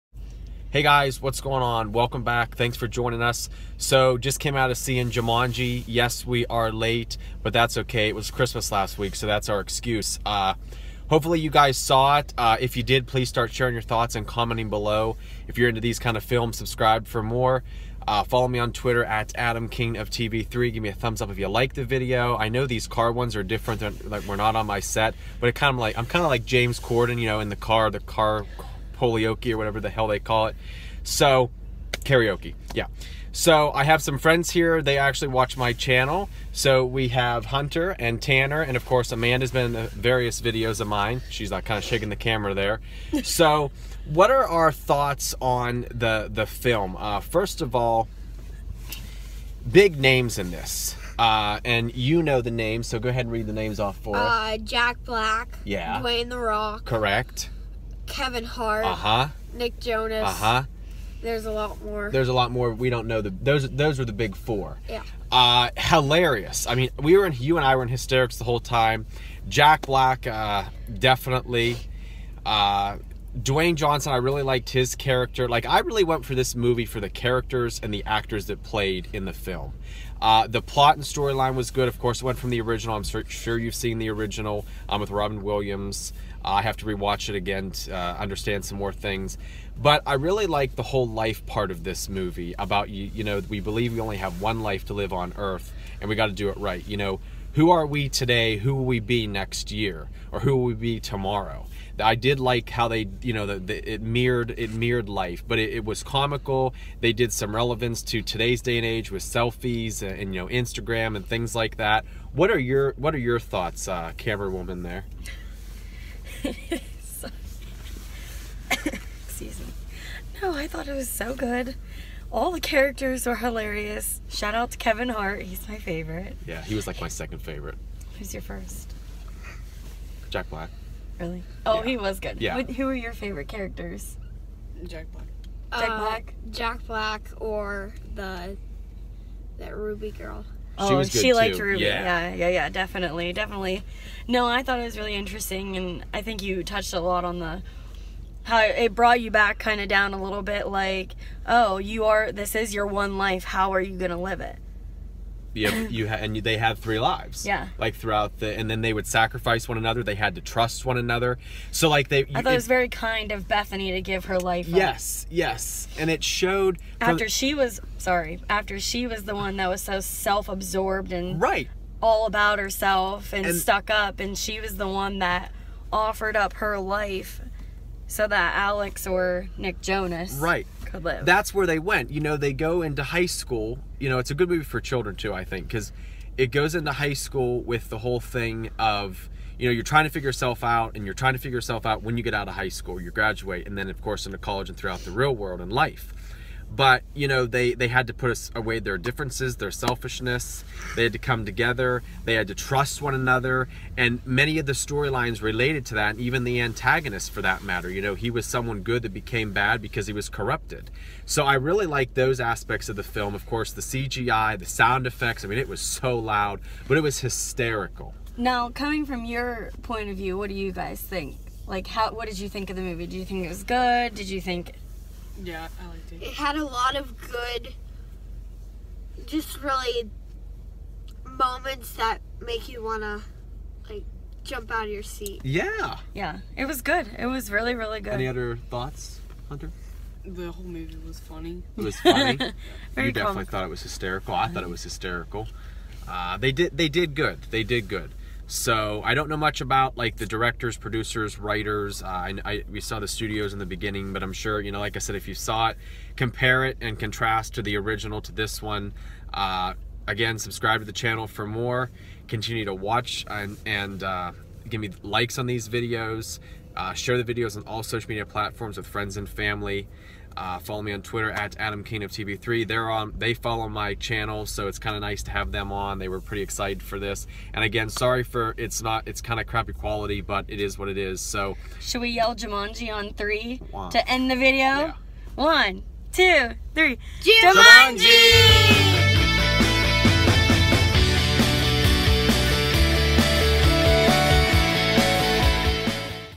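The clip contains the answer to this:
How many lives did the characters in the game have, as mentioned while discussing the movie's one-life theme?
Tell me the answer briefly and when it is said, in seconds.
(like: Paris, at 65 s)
3, at 156 s.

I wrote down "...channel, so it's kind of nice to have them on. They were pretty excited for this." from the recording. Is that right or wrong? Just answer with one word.
right.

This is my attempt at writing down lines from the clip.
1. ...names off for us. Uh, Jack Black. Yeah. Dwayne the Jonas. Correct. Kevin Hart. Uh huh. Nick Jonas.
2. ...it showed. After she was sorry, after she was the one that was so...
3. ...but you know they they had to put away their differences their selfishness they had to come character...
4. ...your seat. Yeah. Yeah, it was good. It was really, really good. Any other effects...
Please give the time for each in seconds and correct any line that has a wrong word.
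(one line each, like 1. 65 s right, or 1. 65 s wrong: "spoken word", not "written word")
1. 53 s wrong: "Rock", not "Jonas"
2. 166 s right
3. 196 s wrong: "together", not "character"
4. 234 s wrong: "thoughts", not "effects".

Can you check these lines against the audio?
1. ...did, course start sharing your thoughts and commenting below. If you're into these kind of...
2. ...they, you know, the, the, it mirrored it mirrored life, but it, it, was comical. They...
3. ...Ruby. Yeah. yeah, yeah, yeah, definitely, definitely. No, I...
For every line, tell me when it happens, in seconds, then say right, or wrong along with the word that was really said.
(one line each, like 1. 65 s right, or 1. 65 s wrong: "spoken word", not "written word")
1. 12 s wrong: "please", not "course"
2. 102 s right
3. 141 s right.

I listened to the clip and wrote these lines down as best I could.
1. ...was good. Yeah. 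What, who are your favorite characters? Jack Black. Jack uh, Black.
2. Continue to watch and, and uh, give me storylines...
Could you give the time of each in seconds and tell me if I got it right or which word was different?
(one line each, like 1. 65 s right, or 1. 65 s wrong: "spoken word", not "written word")
1. 131 s right
2. 262 s wrong: "likes", not "storylines".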